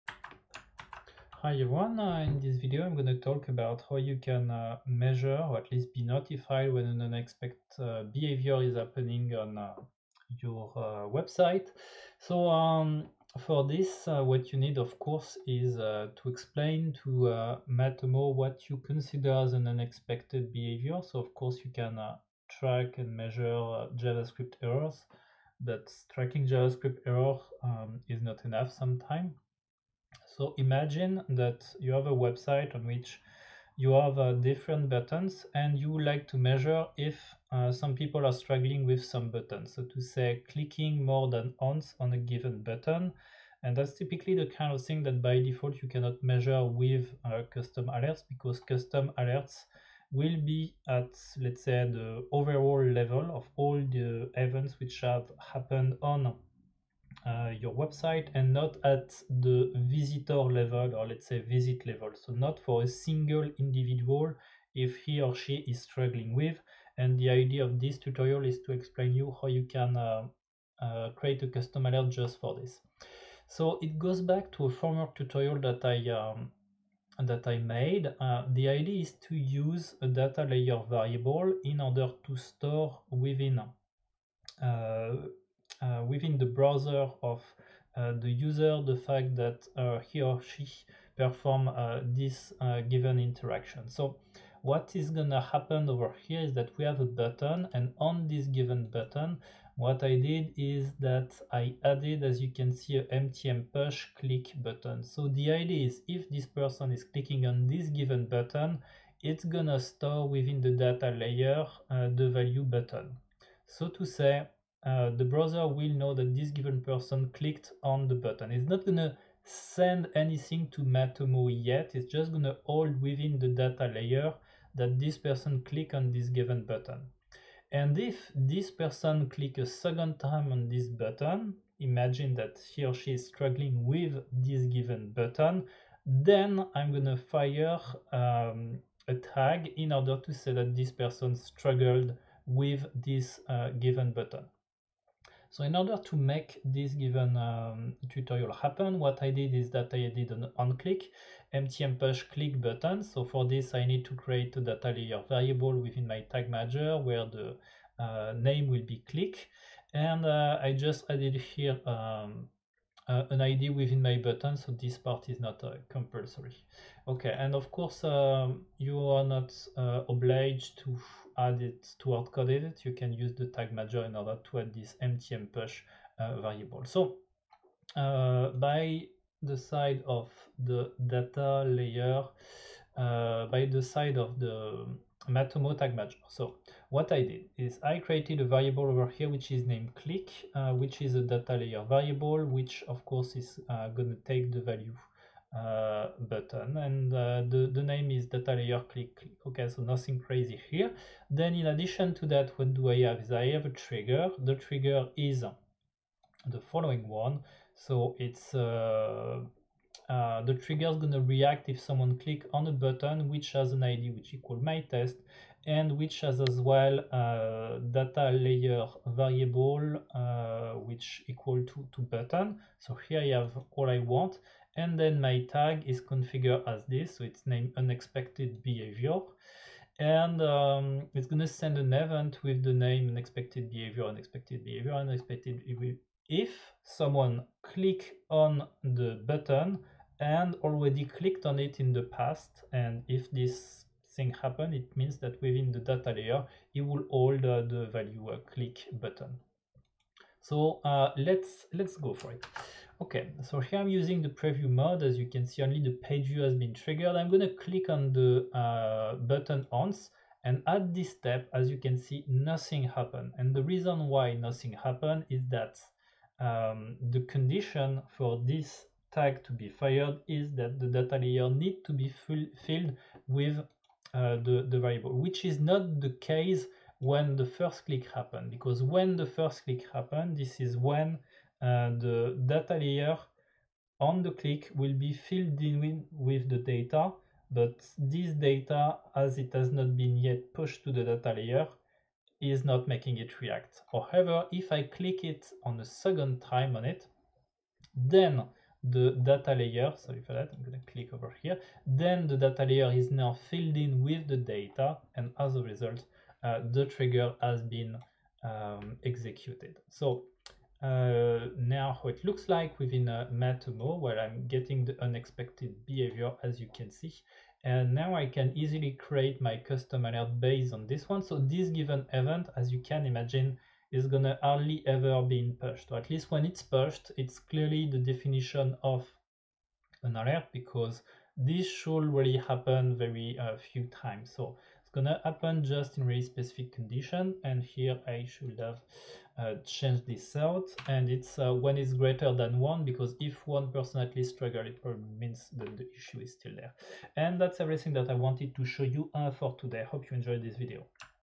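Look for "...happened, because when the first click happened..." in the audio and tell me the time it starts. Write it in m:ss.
4:38.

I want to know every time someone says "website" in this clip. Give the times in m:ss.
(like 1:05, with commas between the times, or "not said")
0:11, 0:32, 0:57.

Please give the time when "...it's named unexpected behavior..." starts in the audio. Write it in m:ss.
3:47.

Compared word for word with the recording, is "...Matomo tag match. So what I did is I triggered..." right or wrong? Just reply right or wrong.
wrong.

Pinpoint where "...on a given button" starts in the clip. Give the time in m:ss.
0:41.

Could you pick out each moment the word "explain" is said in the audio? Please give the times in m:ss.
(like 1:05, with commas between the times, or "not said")
0:16, 1:08.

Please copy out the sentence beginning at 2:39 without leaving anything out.
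And uh, I just added here um, uh, an ID within my button, so this part is not uh, compulsory.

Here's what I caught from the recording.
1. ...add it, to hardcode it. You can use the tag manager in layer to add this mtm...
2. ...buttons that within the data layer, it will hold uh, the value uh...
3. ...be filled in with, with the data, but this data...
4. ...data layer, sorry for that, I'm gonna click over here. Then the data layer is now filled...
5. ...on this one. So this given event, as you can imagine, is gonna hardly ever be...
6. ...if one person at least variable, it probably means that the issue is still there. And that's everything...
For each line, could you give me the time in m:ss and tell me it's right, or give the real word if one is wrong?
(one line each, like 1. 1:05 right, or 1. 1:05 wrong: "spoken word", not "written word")
1. 2:51 wrong: "order", not "layer"
2. 4:04 wrong: "means", not "buttons"
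3. 4:44 right
4. 4:59 right
5. 5:20 right
6. 5:43 wrong: "struggle", not "variable".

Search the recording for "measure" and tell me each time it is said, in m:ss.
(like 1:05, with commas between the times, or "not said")
0:04, 0:23, 0:36, 0:46.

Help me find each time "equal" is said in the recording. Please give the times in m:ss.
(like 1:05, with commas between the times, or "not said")
3:34, 3:41.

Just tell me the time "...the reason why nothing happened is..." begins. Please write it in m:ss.
4:23.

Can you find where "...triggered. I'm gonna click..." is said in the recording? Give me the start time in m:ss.
4:16.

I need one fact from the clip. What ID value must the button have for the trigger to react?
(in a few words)
my test.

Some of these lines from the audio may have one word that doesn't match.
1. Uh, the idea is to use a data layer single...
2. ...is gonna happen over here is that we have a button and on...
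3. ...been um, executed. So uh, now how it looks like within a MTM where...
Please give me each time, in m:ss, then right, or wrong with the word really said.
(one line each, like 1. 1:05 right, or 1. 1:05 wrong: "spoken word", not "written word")
1. 1:18 wrong: "variable", not "single"
2. 1:34 right
3. 5:07 wrong: "Matomo", not "MTM".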